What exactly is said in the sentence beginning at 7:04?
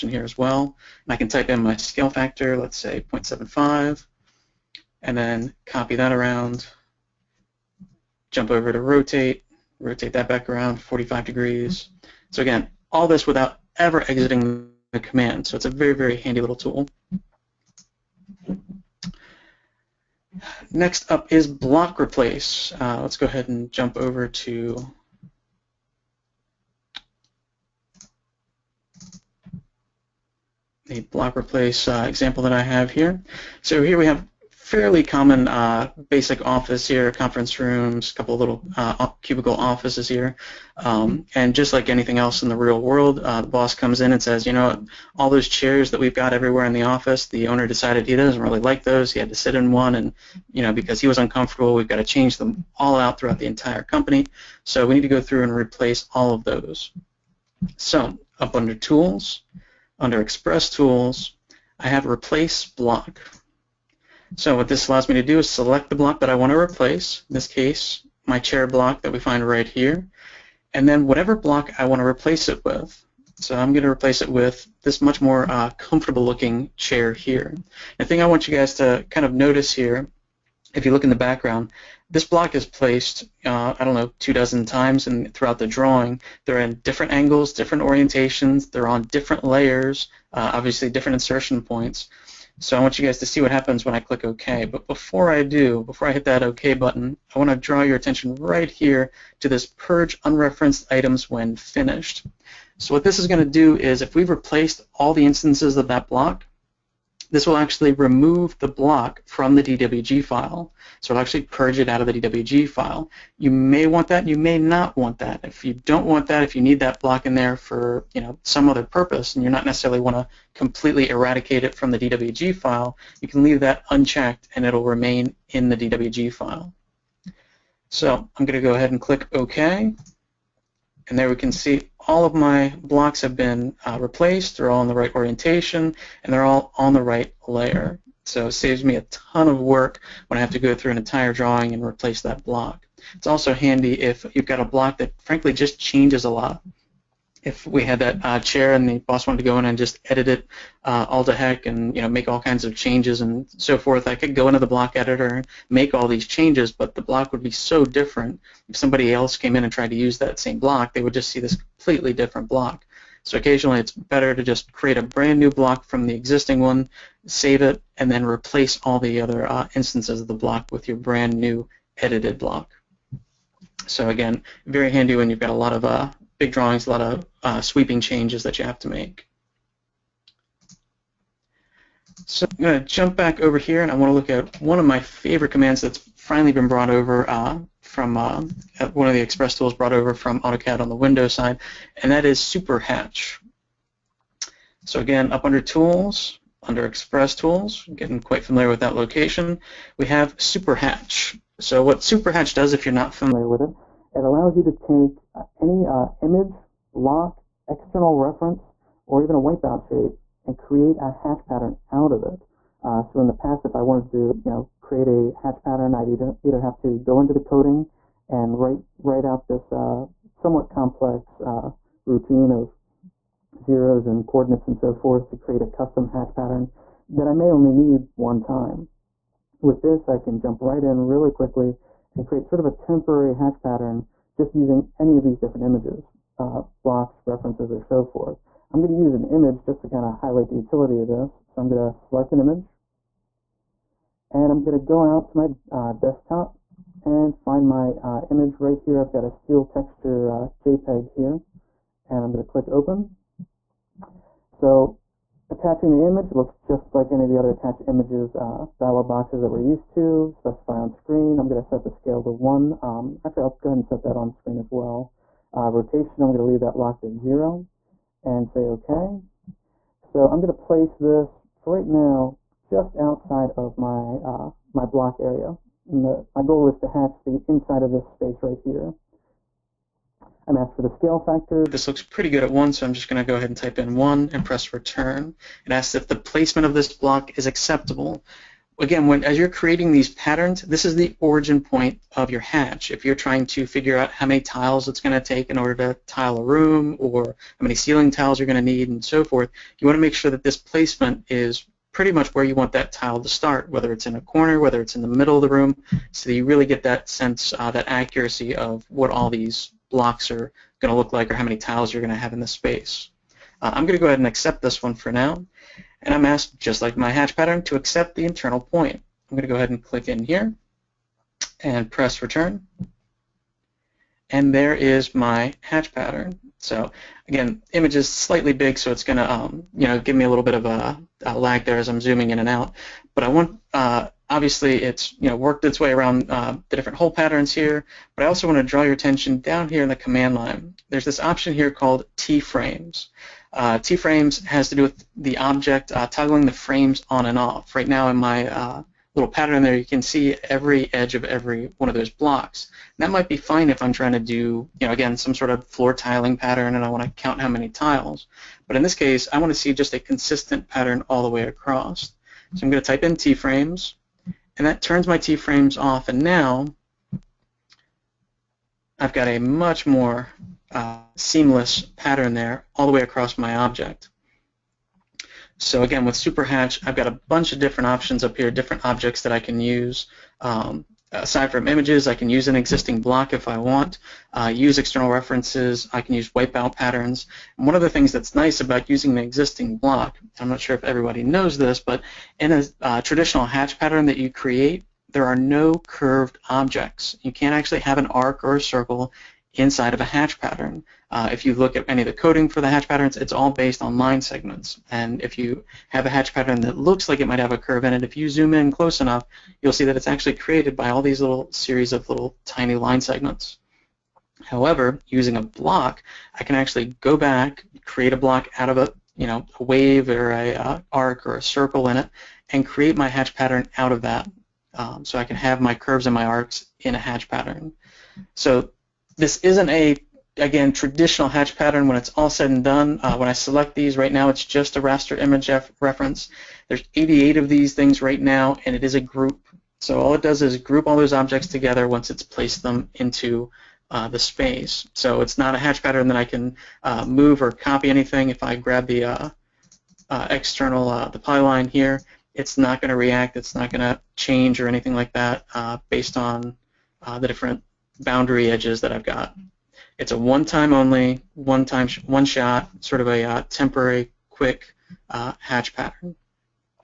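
Um, so I can have my curves and my arcs in a hatch pattern.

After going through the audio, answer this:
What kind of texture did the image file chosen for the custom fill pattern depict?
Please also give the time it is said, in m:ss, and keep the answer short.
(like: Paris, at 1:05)
Steel, at 4:09.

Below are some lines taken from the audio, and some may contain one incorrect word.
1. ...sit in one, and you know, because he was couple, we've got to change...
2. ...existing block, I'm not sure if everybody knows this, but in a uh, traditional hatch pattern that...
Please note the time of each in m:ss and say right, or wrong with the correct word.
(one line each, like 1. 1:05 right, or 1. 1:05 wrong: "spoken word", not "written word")
1. 0:49 wrong: "uncomfortable", not "couple"
2. 6:29 right.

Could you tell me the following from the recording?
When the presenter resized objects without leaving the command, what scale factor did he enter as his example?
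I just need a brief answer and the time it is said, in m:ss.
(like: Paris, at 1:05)
0.75, at 0:03.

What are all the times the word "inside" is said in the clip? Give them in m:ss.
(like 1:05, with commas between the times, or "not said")
4:37, 6:39.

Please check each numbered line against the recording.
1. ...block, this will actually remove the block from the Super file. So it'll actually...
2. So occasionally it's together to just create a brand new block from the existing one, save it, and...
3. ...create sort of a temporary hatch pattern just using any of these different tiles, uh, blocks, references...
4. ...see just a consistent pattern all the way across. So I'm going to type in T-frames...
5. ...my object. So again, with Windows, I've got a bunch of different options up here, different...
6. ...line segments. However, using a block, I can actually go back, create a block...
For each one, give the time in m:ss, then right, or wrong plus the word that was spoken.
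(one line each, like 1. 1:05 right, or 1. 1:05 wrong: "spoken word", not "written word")
1. 1:46 wrong: "DWG", not "Super"
2. 2:43 wrong: "better", not "together"
3. 3:52 wrong: "images", not "tiles"
4. 5:59 right
5. 6:13 wrong: "SuperHatch", not "Windows"
6. 6:52 right.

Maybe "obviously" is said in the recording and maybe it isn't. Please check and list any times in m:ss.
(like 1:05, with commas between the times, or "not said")
1:30, 5:34.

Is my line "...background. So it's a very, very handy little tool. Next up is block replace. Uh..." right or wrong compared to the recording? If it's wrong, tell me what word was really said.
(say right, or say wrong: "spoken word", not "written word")
wrong: "command", not "background".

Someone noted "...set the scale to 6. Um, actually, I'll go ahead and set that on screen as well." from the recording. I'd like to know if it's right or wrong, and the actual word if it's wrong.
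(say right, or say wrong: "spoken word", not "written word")
wrong: "1", not "6".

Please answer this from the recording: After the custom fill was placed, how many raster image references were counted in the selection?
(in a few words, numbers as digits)
88.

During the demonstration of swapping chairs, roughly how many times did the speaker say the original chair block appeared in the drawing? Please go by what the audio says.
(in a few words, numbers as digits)
two dozen.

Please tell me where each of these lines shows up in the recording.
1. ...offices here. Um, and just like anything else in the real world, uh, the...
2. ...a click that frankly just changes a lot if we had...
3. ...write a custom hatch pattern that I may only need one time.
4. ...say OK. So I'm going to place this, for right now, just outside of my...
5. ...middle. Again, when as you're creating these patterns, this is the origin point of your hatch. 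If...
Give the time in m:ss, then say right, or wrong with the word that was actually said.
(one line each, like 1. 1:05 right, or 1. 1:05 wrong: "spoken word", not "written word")
1. 0:39 right
2. 2:24 wrong: "block", not "click"
3. 3:45 wrong: "create", not "write"
4. 4:28 right
5. 4:47 wrong: "acceptable", not "middle".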